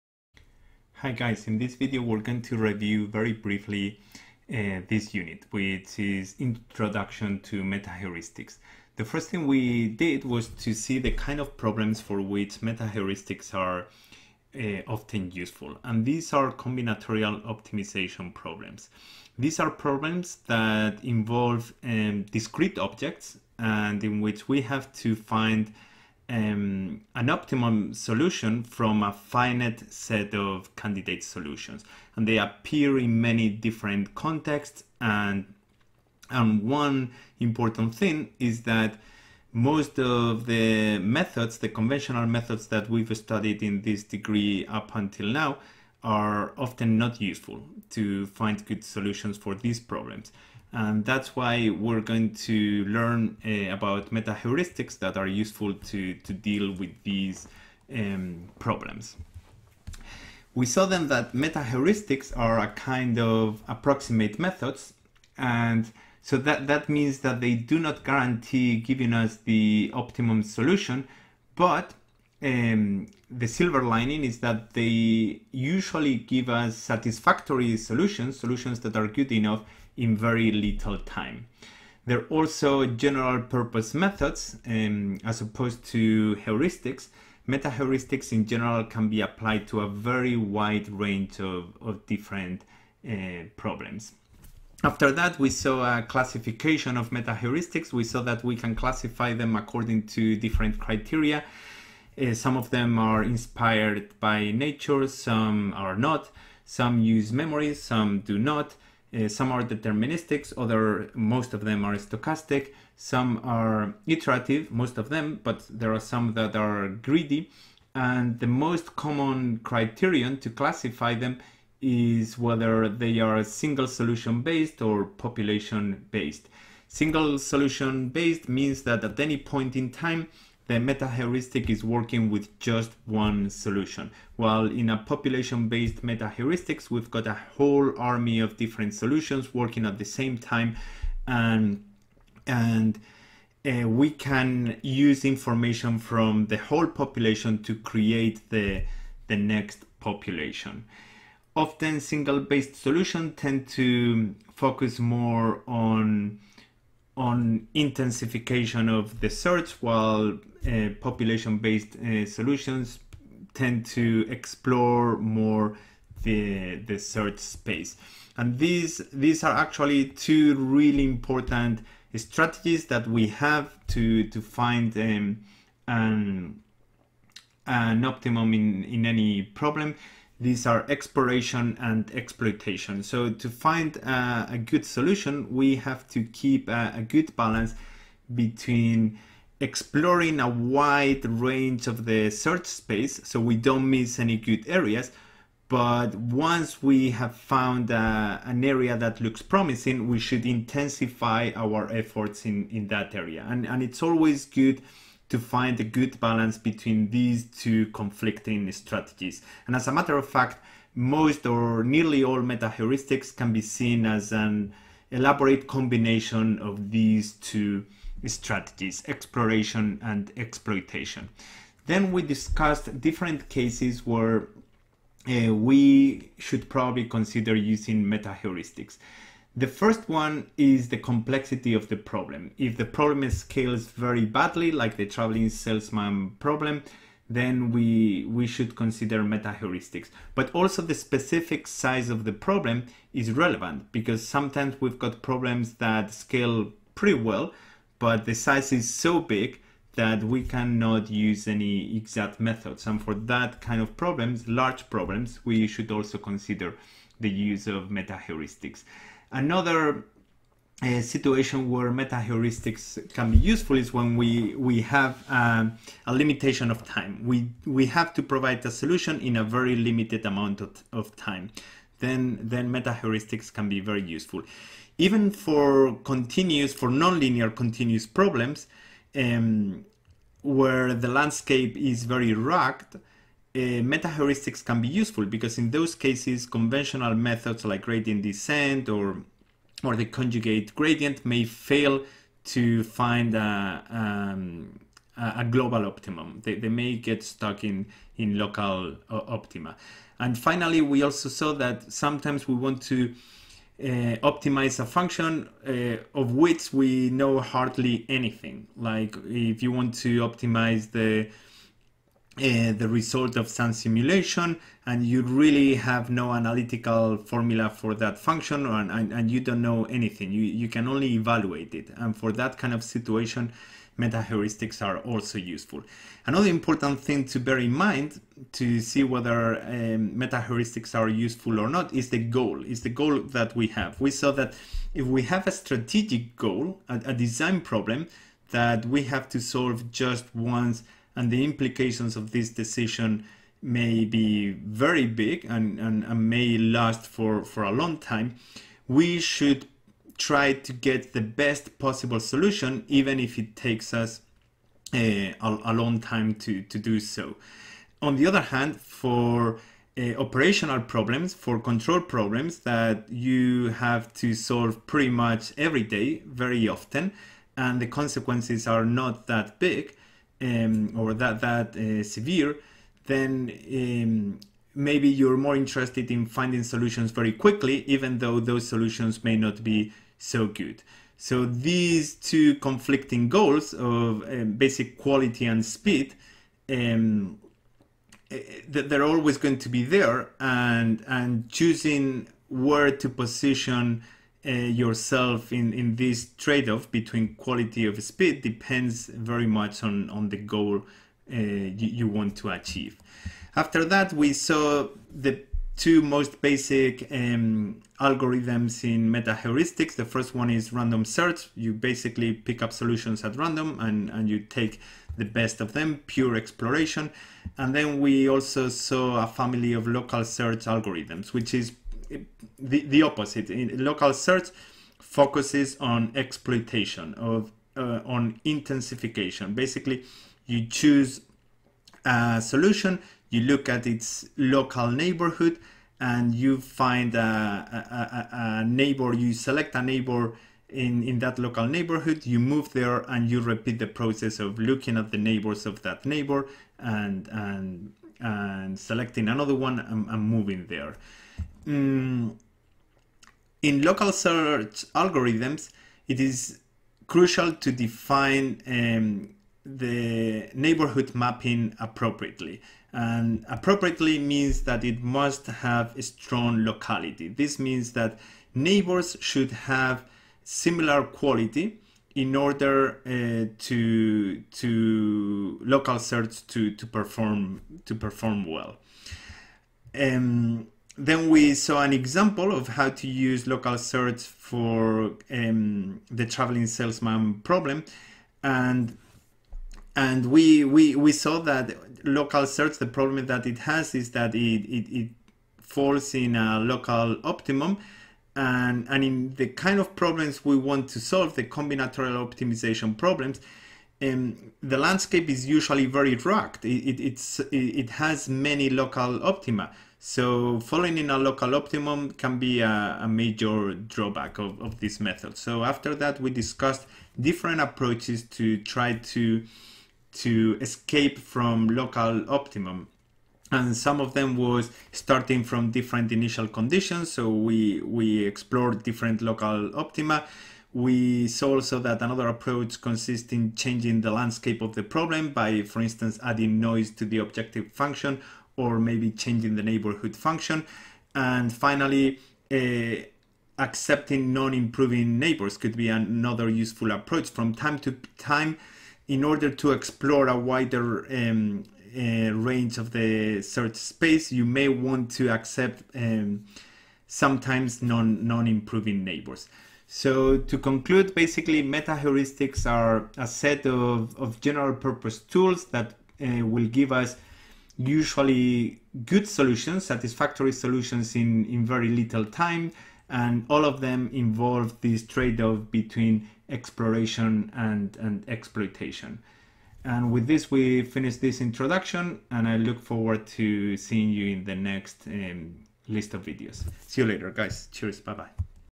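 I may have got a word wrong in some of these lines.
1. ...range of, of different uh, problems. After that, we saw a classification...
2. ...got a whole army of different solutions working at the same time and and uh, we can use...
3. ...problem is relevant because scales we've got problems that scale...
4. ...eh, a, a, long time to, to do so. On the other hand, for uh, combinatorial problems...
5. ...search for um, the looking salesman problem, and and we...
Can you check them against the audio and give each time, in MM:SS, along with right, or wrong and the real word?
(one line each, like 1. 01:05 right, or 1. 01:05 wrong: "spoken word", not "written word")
1. 01:30 right
2. 02:17 right
3. 04:02 wrong: "sometimes", not "scales"
4. 05:54 wrong: "operational", not "combinatorial"
5. 08:03 wrong: "traveling", not "looking".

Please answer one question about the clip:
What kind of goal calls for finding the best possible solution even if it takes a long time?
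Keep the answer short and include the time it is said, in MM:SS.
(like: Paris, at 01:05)
Strategic goal, at 05:35.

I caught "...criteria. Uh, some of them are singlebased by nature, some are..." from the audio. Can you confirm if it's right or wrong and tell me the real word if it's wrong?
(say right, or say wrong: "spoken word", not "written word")
wrong: "inspired", not "singlebased".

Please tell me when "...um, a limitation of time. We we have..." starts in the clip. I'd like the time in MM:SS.
04:25.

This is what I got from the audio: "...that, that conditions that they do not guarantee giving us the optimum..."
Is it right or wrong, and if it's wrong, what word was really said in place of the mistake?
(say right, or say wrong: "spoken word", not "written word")
wrong: "means", not "conditions".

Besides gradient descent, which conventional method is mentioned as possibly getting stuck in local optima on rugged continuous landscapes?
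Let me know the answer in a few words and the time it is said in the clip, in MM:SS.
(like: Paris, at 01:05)
Conjugate gradient, at 04:50.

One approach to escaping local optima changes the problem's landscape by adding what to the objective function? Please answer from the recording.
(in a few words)
Noise.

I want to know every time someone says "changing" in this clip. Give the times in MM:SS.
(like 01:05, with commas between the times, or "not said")
08:53, 08:59.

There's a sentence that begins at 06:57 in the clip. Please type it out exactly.
And then we also saw a family of local search algorithms, which is the, the opposite.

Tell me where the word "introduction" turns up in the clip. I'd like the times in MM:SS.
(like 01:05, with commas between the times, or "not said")
00:06, 09:41.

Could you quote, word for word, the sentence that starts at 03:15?
But once we have found uh, an area that looks promising, we should intensify our efforts in, in that area.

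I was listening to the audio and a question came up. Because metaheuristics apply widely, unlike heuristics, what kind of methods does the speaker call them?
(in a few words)
General purpose methods.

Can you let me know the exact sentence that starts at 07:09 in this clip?
Basically, you choose a solution, you look at its local neighborhood, and you find a, a, a neighbor.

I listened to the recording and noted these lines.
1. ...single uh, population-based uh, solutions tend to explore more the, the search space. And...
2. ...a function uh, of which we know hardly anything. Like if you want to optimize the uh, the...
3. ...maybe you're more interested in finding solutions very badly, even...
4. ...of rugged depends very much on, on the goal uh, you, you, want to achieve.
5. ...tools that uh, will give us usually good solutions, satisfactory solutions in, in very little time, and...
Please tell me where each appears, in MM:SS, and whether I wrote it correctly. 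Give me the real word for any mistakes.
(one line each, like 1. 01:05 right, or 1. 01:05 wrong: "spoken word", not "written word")
1. 02:39 wrong: "while", not "single"
2. 05:04 right
3. 06:14 wrong: "quickly", not "badly"
4. 06:37 wrong: "speed", not "rugged"
5. 09:25 right.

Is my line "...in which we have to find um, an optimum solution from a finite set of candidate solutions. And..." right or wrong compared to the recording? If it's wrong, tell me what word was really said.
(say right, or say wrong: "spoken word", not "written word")
right.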